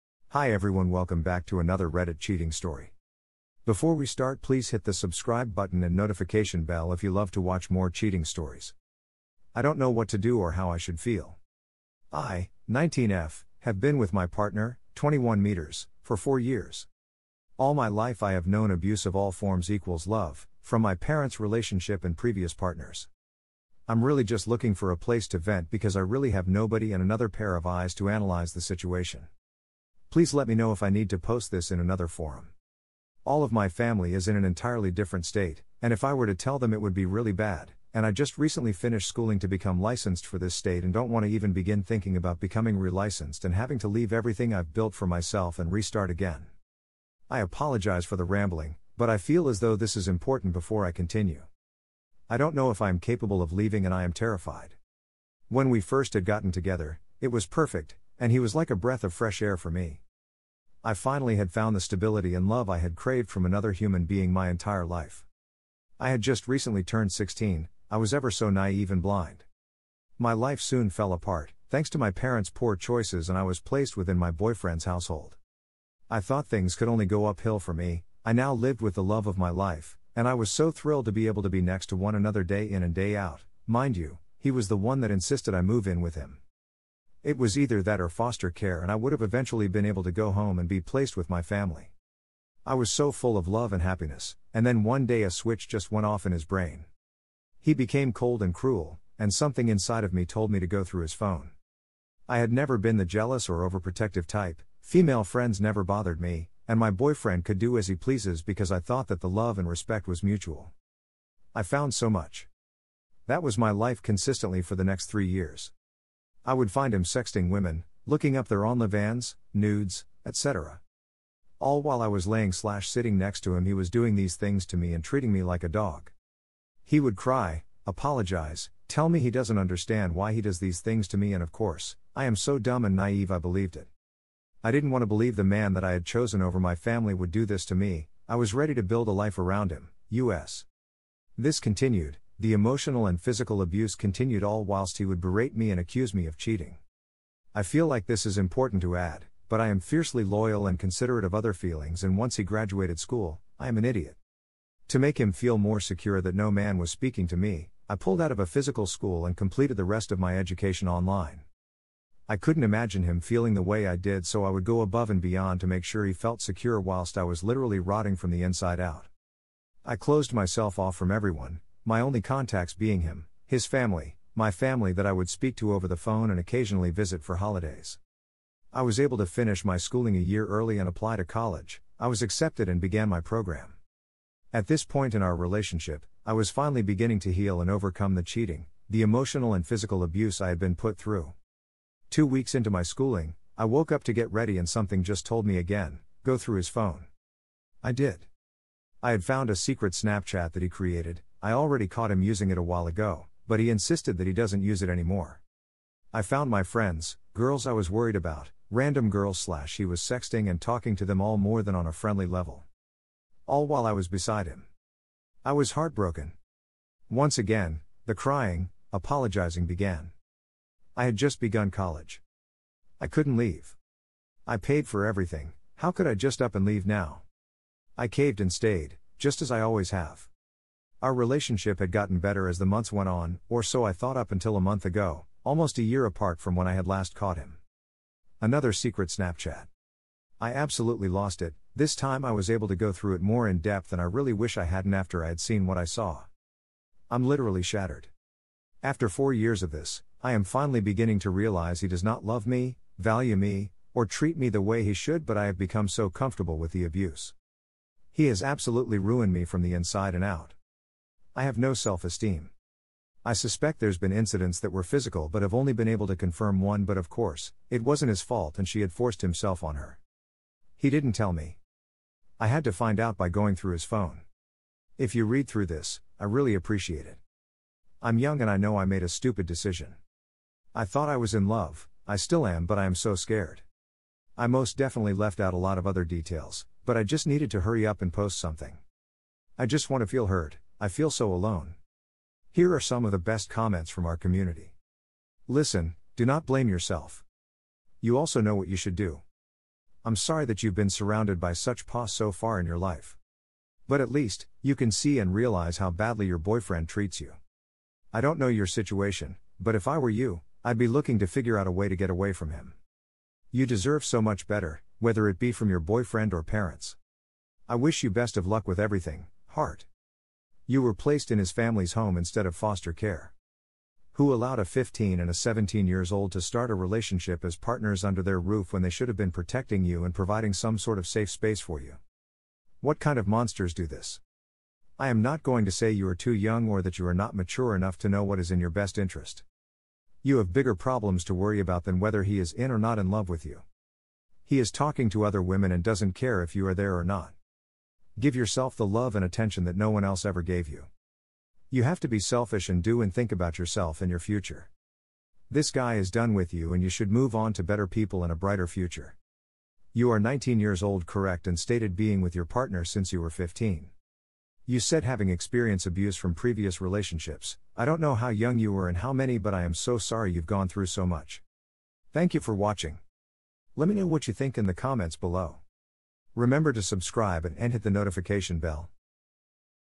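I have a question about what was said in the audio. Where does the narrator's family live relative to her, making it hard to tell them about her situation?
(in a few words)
An entirely different state.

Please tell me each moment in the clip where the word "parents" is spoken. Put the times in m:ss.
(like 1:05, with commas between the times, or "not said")
0:20, 1:12, 5:16.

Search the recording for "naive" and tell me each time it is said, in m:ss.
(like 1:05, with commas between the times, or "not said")
1:08, 2:12.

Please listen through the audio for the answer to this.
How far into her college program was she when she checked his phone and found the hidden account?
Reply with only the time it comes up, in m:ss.
3:12.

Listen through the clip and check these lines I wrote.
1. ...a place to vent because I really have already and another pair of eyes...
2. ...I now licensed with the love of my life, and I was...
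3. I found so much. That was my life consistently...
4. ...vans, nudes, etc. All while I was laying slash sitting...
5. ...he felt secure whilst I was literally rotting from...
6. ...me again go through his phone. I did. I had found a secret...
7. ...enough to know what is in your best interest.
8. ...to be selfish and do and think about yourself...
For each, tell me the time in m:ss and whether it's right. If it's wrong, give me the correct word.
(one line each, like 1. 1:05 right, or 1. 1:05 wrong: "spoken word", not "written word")
1. 0:24 wrong: "nobody", not "already"
2. 1:18 wrong: "lived", not "licensed"
3. 1:51 right
4. 1:58 right
5. 2:46 right
6. 3:15 right
7. 5:37 right
8. 5:52 right.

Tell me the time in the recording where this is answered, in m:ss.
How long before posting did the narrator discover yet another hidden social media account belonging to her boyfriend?
3:54.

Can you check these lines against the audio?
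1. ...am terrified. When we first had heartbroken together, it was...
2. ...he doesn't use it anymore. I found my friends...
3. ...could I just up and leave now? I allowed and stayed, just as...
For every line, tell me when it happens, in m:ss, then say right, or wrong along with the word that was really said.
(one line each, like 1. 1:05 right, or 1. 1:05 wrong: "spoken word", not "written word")
1. 0:54 wrong: "gotten", not "heartbroken"
2. 3:24 right
3. 3:45 wrong: "caved", not "allowed".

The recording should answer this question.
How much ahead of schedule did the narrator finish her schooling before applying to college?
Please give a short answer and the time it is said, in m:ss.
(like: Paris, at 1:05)
A year early, at 3:00.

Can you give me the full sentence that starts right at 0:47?
I apologize for the rambling, but I feel as though this is important before I continue.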